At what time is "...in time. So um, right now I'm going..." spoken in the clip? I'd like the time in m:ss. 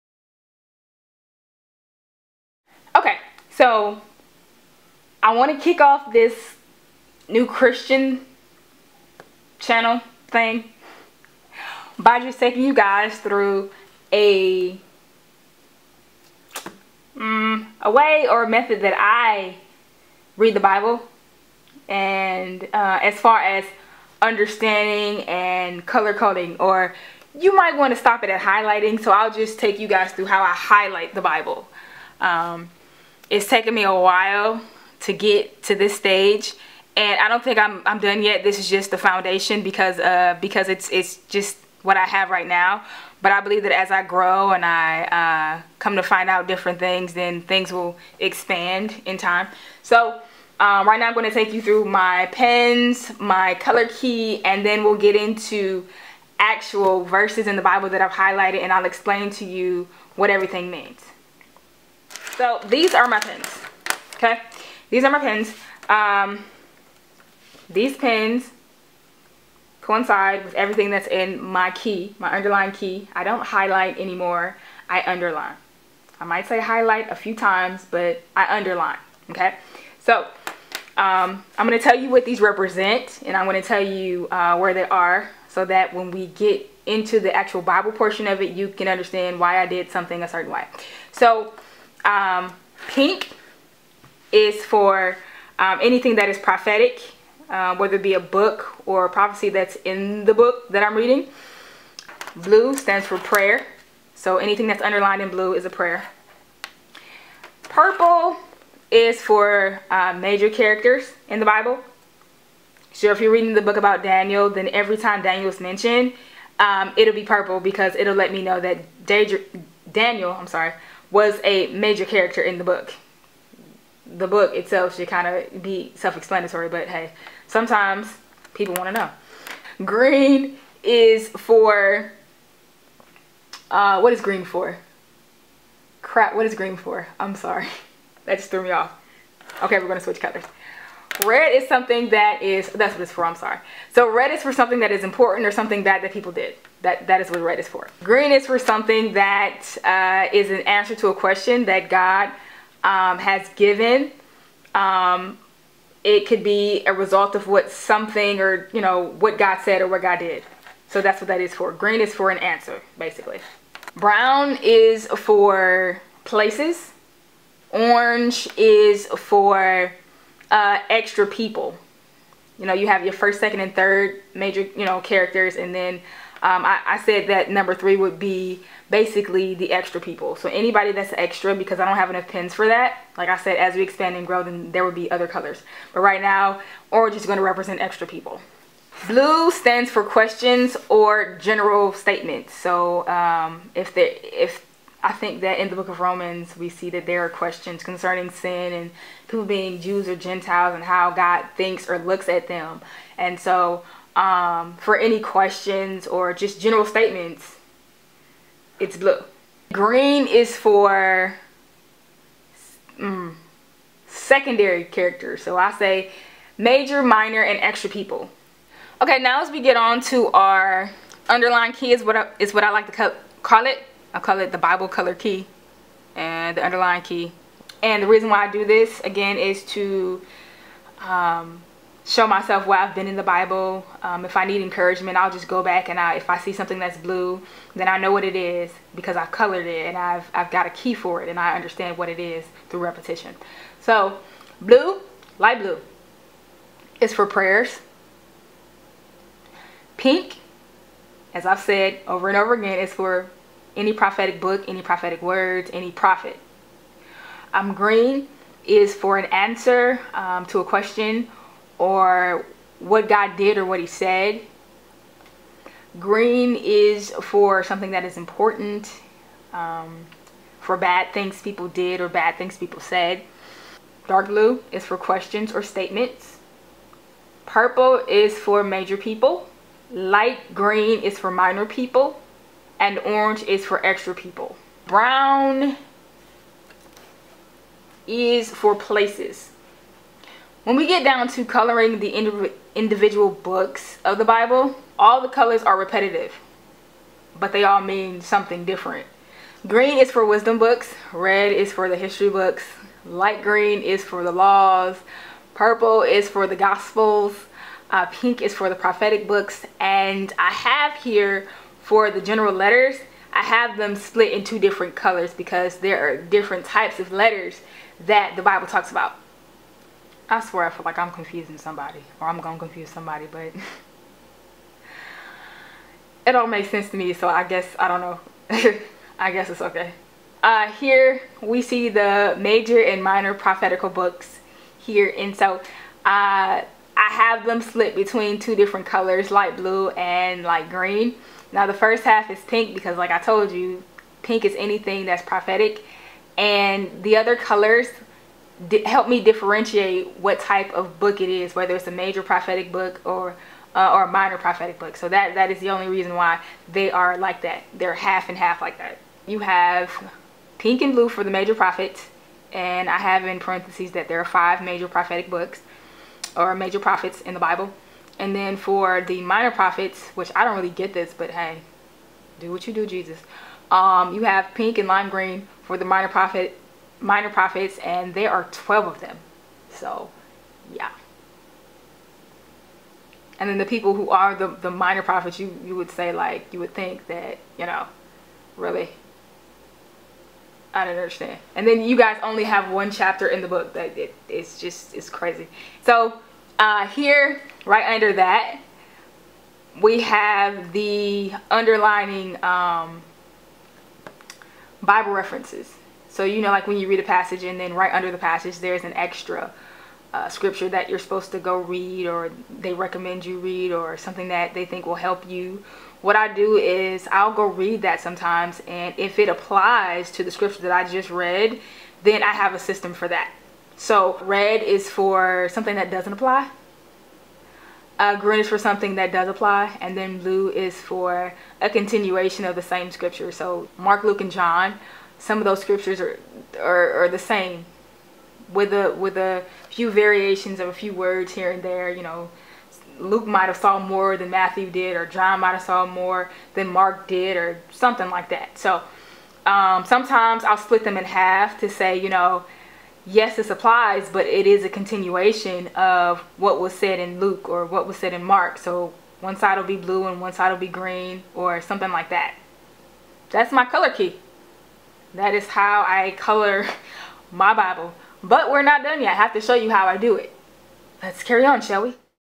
0:49.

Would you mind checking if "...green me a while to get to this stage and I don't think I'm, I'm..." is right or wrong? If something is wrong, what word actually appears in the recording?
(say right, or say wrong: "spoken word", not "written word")
wrong: "taken", not "green".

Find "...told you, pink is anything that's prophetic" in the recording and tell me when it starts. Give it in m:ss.
5:43.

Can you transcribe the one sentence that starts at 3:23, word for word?
And so, um, for any questions or just general statements, it's blue.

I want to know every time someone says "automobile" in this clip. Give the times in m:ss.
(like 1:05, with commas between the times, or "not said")
not said.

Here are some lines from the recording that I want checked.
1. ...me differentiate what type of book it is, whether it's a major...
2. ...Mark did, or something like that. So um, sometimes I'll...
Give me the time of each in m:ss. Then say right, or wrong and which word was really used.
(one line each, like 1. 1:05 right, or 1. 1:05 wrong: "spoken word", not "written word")
1. 5:49 right
2. 7:26 right.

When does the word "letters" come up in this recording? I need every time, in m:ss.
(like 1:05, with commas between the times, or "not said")
5:12, 5:17.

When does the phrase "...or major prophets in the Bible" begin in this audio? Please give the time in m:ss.
6:06.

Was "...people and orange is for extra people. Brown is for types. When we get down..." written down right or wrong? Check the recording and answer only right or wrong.
wrong.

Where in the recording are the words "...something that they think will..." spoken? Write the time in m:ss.
6:53.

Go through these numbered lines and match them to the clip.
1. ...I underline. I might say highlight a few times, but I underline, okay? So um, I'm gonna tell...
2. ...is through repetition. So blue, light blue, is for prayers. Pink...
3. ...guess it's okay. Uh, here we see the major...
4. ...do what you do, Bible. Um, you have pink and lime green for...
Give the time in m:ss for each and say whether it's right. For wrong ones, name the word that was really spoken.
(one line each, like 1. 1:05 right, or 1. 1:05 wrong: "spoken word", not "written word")
1. 1:14 right
2. 4:02 right
3. 5:29 right
4. 6:12 wrong: "Jesus", not "Bible".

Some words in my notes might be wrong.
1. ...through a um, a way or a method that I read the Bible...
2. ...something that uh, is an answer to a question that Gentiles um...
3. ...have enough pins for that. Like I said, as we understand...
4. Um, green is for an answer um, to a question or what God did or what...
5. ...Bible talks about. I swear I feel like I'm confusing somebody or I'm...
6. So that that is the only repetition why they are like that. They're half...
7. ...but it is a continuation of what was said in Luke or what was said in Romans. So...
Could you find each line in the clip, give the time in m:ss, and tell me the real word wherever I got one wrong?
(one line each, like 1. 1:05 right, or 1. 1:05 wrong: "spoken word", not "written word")
1. 0:13 right
2. 2:28 wrong: "God", not "Gentiles"
3. 3:01 wrong: "expand", not "understand"
4. 4:17 right
5. 5:18 right
6. 5:54 wrong: "reason", not "repetition"
7. 7:34 wrong: "Mark", not "Romans".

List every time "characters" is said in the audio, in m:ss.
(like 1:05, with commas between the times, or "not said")
1:50, 2:02, 2:54, 3:34.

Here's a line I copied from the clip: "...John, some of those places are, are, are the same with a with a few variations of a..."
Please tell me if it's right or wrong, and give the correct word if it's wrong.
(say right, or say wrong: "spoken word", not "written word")
wrong: "scriptures", not "places".